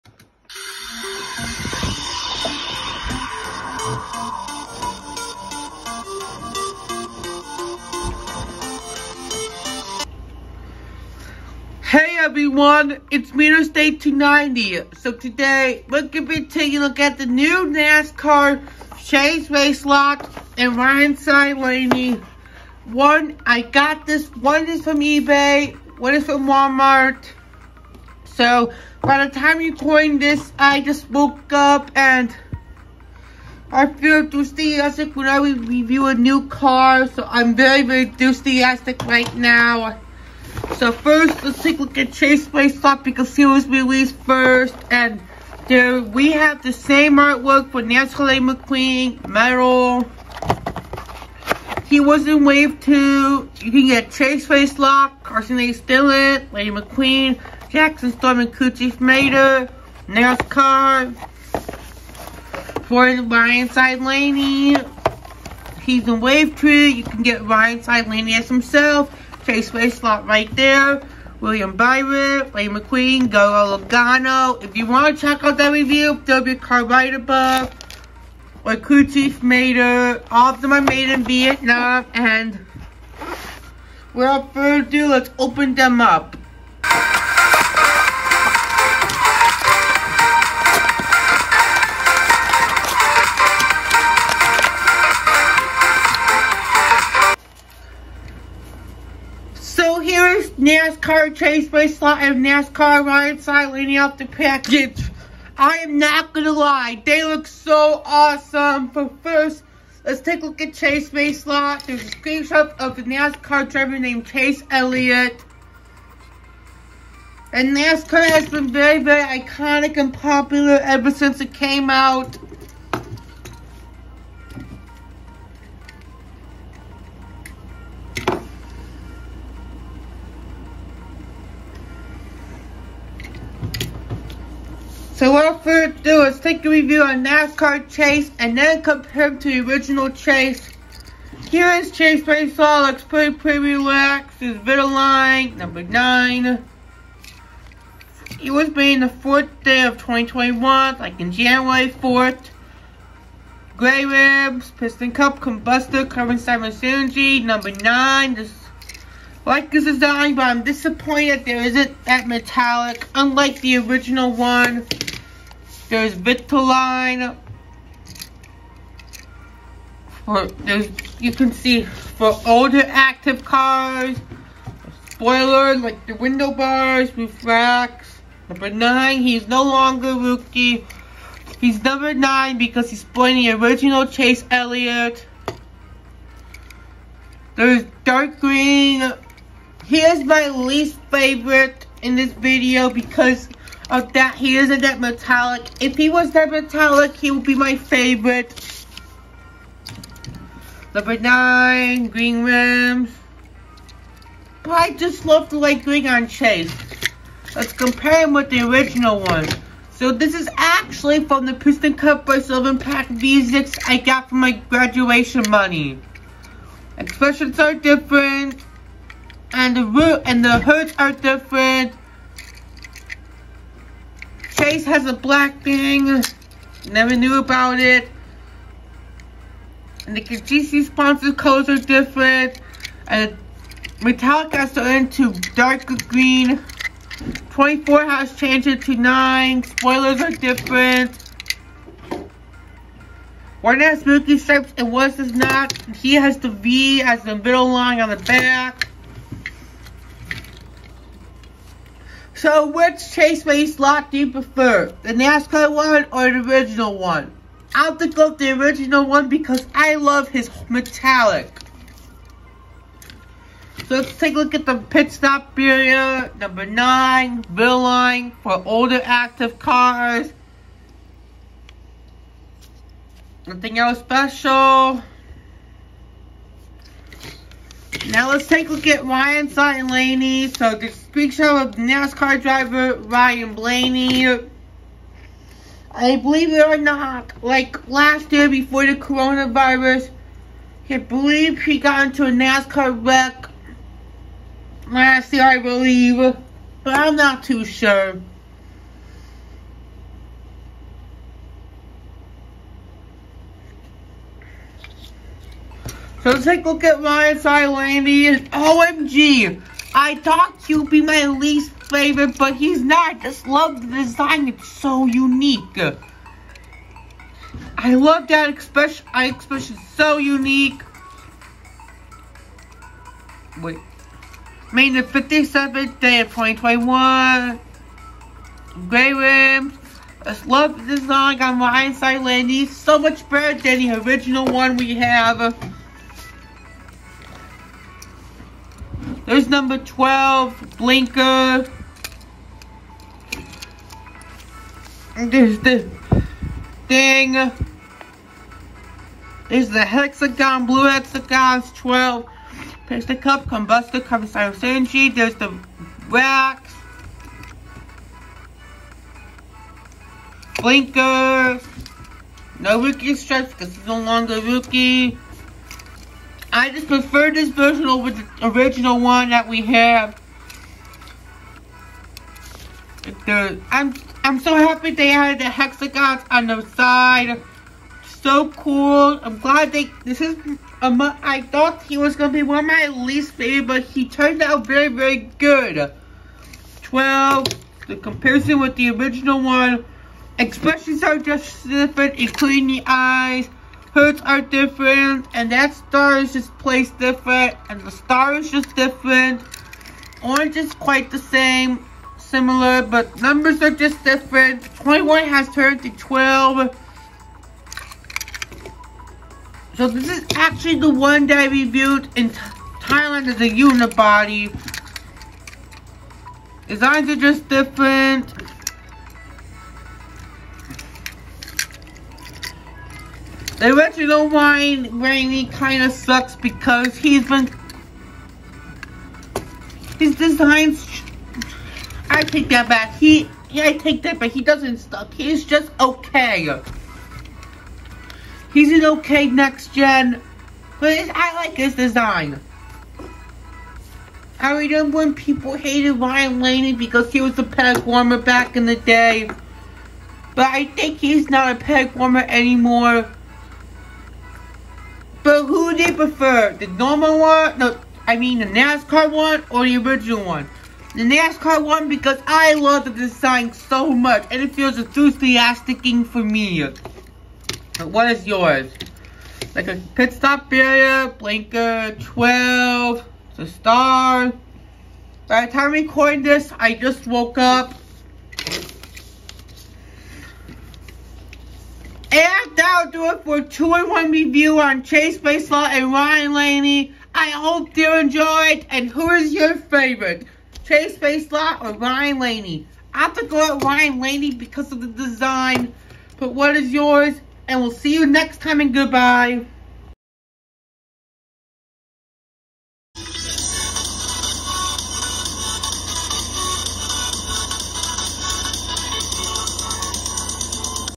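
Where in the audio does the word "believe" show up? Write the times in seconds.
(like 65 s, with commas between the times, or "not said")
286 s, 290 s, 295 s.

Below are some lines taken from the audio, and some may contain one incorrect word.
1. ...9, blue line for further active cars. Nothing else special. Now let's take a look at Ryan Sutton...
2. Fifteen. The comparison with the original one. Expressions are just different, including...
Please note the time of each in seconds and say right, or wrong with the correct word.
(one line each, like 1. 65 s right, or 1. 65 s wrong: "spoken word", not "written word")
1. 266 s wrong: "older", not "further"
2. 386 s wrong: "Twelve", not "Fifteen".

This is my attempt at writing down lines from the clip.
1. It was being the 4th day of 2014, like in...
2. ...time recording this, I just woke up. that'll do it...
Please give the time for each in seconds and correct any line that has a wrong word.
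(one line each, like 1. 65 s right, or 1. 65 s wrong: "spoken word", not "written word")
1. 148 s wrong: "2021", not "2014"
2. 475 s right.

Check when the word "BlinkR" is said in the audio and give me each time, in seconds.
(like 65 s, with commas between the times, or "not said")
340 s, 360 s, 471 s.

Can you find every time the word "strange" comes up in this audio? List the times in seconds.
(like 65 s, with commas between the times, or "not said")
not said.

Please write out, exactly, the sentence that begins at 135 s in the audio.
So without further ado, let's take a review on NASCAR Chase and then compare him to the original Chase.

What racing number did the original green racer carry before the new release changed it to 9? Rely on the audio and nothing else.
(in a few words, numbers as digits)
24.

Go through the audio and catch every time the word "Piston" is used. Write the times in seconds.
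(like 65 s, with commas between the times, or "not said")
154 s, 211 s.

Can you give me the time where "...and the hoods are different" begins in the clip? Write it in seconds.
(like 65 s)
220 s.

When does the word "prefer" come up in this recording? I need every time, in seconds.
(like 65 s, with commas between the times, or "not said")
254 s, 366 s, 455 s.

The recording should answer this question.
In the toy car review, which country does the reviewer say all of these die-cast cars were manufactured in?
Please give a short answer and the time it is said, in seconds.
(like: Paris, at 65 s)
Vietnam, at 81 s.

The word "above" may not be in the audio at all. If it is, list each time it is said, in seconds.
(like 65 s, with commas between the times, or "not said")
77 s.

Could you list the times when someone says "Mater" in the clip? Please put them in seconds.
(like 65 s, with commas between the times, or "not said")
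58 s, 79 s.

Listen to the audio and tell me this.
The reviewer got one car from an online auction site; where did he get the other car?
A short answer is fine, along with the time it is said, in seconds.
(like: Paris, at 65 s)
Walmart, at 26 s.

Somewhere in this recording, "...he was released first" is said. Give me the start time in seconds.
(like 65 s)
42 s.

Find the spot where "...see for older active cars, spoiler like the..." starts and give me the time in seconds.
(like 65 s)
171 s.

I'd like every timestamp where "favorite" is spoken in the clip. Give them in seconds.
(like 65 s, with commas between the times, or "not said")
191 s, 197 s, 311 s, 383 s, 489 s.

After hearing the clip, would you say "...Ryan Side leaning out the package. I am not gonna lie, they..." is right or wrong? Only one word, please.
right.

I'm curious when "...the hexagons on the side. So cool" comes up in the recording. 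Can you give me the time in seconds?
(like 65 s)
375 s.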